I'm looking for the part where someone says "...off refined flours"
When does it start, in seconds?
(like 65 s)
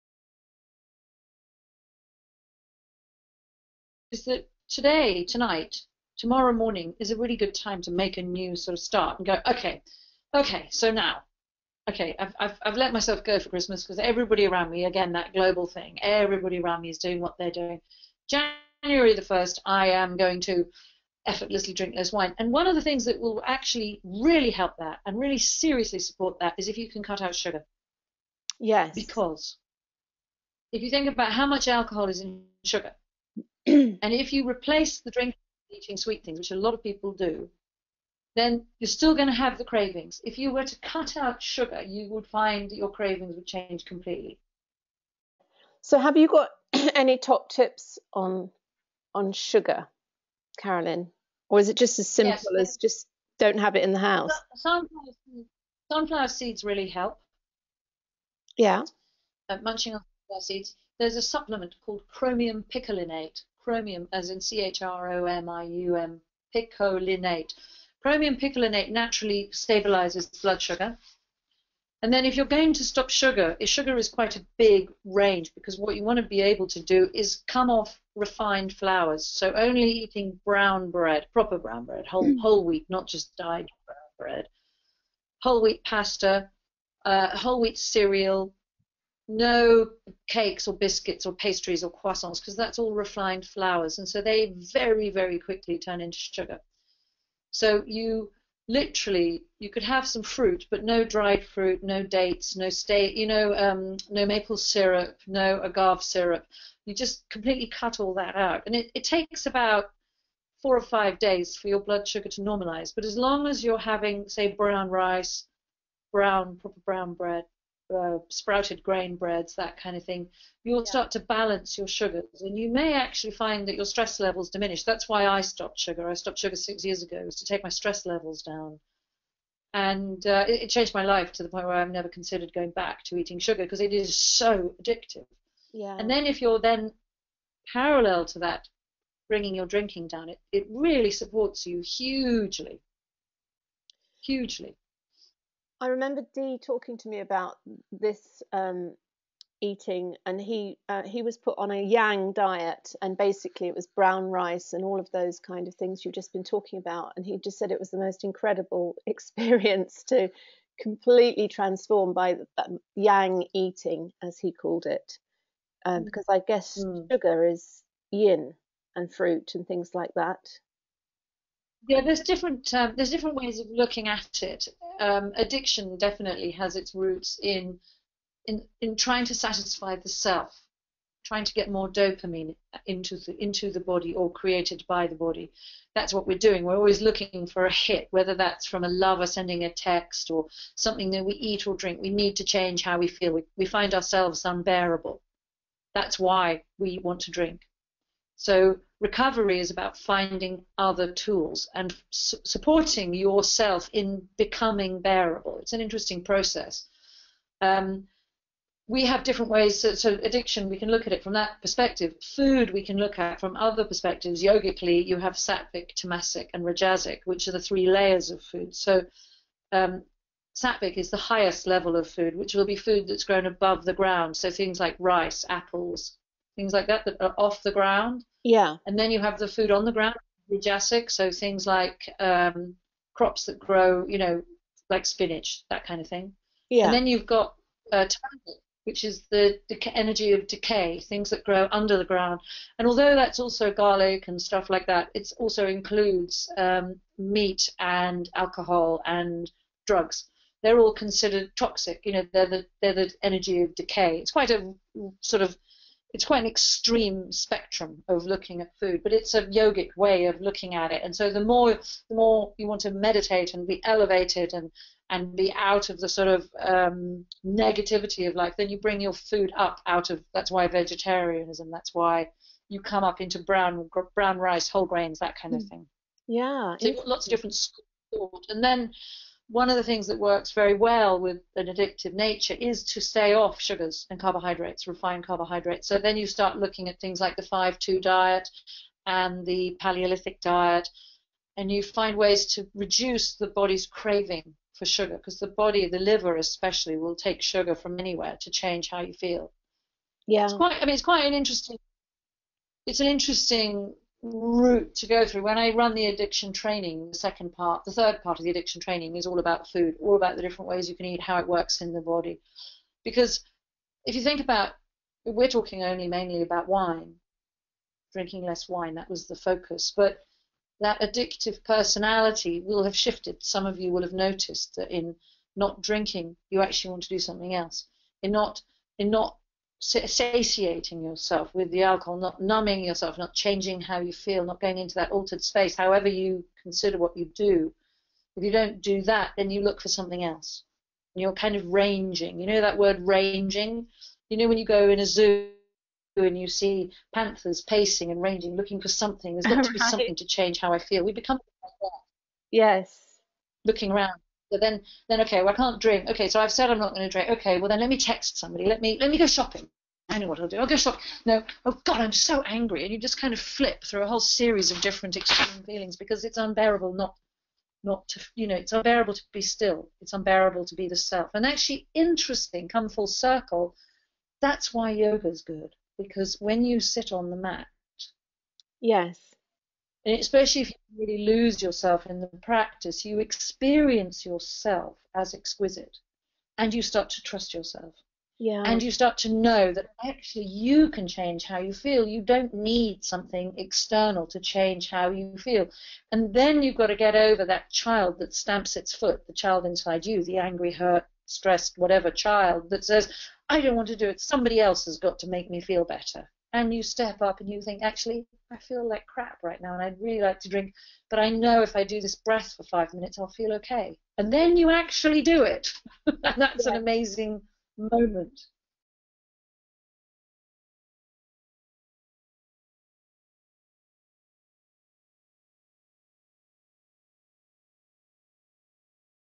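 77 s.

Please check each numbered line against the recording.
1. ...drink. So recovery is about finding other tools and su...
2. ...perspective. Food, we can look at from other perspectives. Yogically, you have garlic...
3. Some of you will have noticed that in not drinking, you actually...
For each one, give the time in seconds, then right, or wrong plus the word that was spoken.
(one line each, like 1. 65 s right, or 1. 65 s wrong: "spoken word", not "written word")
1. 197 s right
2. 211 s wrong: "sattvic", not "garlic"
3. 323 s right.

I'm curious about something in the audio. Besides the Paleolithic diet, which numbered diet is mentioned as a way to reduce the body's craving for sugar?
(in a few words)
5-2 diet.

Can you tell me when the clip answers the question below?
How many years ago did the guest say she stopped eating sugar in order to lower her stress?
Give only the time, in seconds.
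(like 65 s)
126 s.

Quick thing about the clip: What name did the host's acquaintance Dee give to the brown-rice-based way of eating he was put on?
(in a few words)
Yang eating.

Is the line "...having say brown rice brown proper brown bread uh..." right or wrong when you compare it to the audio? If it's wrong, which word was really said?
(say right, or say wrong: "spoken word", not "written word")
right.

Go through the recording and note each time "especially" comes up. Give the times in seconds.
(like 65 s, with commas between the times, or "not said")
296 s, 380 s.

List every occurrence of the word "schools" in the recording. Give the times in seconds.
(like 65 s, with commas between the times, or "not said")
277 s.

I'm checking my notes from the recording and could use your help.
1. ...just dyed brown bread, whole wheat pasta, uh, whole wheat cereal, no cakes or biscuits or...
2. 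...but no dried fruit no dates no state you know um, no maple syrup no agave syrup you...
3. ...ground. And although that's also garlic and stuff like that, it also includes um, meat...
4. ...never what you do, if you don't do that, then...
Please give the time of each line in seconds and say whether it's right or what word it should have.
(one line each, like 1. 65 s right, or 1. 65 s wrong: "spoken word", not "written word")
1. 83 s right
2. 100 s right
3. 242 s right
4. 336 s wrong: "consider", not "never".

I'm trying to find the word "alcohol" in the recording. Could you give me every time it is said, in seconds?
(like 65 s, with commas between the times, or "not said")
31 s, 248 s, 331 s.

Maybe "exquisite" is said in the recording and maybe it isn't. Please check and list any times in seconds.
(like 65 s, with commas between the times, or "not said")
385 s.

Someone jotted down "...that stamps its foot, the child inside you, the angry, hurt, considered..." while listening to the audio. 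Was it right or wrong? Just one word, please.
wrong.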